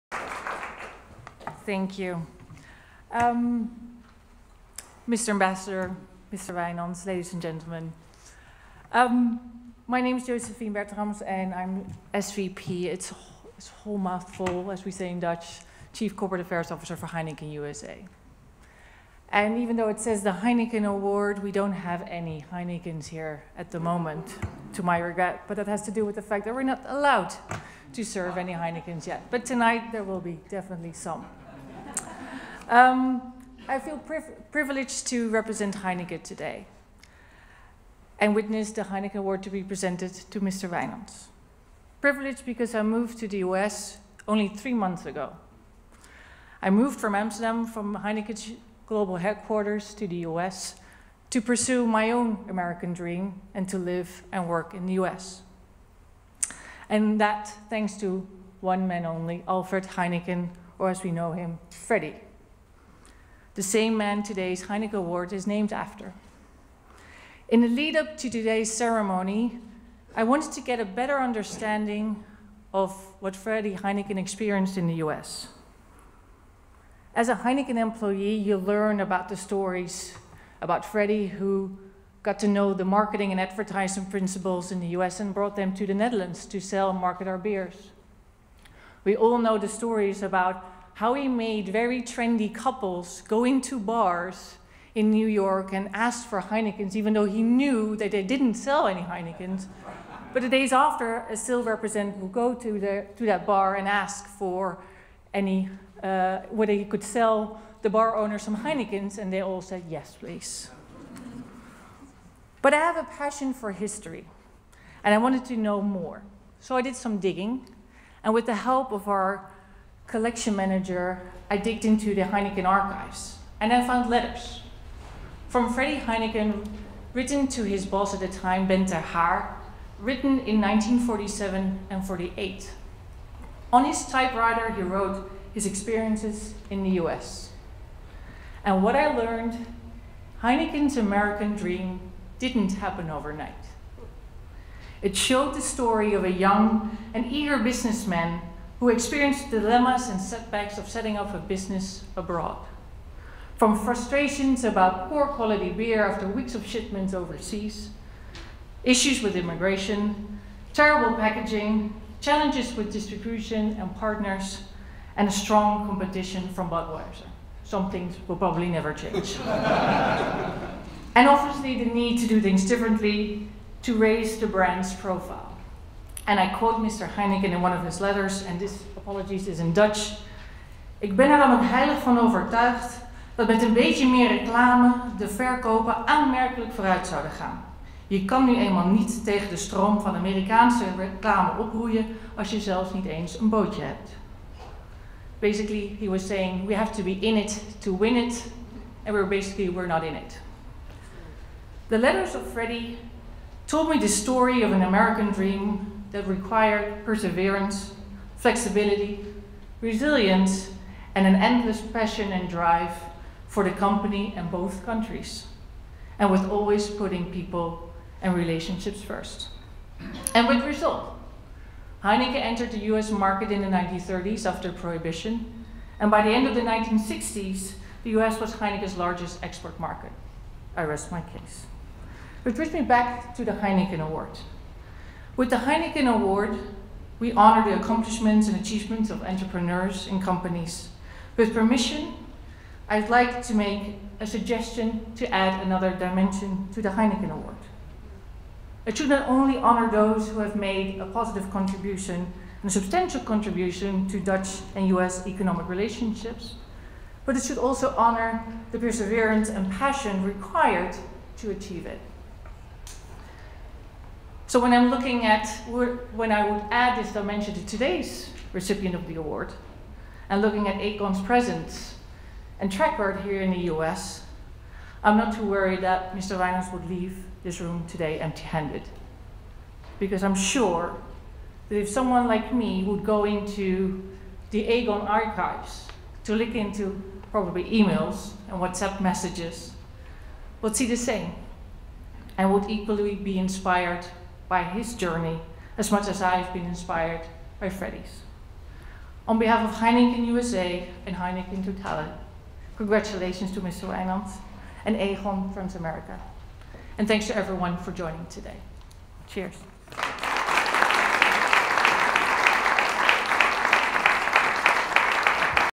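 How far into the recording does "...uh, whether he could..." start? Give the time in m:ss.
1:46.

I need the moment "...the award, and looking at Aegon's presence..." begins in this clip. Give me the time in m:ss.
4:29.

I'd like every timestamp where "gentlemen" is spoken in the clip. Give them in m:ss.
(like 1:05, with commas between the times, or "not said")
0:07.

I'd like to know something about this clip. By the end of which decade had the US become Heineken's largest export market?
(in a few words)
1960s.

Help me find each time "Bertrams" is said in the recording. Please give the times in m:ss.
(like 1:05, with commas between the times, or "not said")
0:10.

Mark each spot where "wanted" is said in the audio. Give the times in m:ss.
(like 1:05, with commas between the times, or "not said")
1:10, 1:55.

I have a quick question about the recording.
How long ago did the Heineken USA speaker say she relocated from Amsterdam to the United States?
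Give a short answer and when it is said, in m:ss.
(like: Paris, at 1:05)
3 months, at 0:44.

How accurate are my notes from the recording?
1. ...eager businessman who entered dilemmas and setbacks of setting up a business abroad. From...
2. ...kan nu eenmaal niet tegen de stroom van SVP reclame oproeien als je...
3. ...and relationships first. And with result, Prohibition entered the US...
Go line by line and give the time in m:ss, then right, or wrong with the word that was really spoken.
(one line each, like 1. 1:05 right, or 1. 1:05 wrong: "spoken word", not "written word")
1. 2:27 wrong: "experienced", not "entered"
2. 3:08 wrong: "Amerikaanse", not "SVP"
3. 3:38 wrong: "Heineken", not "Prohibition".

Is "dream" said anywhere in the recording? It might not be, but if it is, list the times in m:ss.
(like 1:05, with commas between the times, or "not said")
0:52, 2:21, 3:25.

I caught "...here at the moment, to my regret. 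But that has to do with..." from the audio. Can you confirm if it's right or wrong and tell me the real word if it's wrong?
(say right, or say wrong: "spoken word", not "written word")
right.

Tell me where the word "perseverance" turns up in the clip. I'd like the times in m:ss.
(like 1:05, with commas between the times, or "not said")
3:27, 4:18.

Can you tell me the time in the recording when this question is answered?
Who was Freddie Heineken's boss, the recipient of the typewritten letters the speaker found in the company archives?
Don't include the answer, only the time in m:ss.
2:08.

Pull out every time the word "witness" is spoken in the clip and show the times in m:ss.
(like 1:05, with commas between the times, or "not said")
0:38.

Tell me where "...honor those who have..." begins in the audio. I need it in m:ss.
4:09.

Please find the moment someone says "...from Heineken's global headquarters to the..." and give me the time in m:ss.
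0:47.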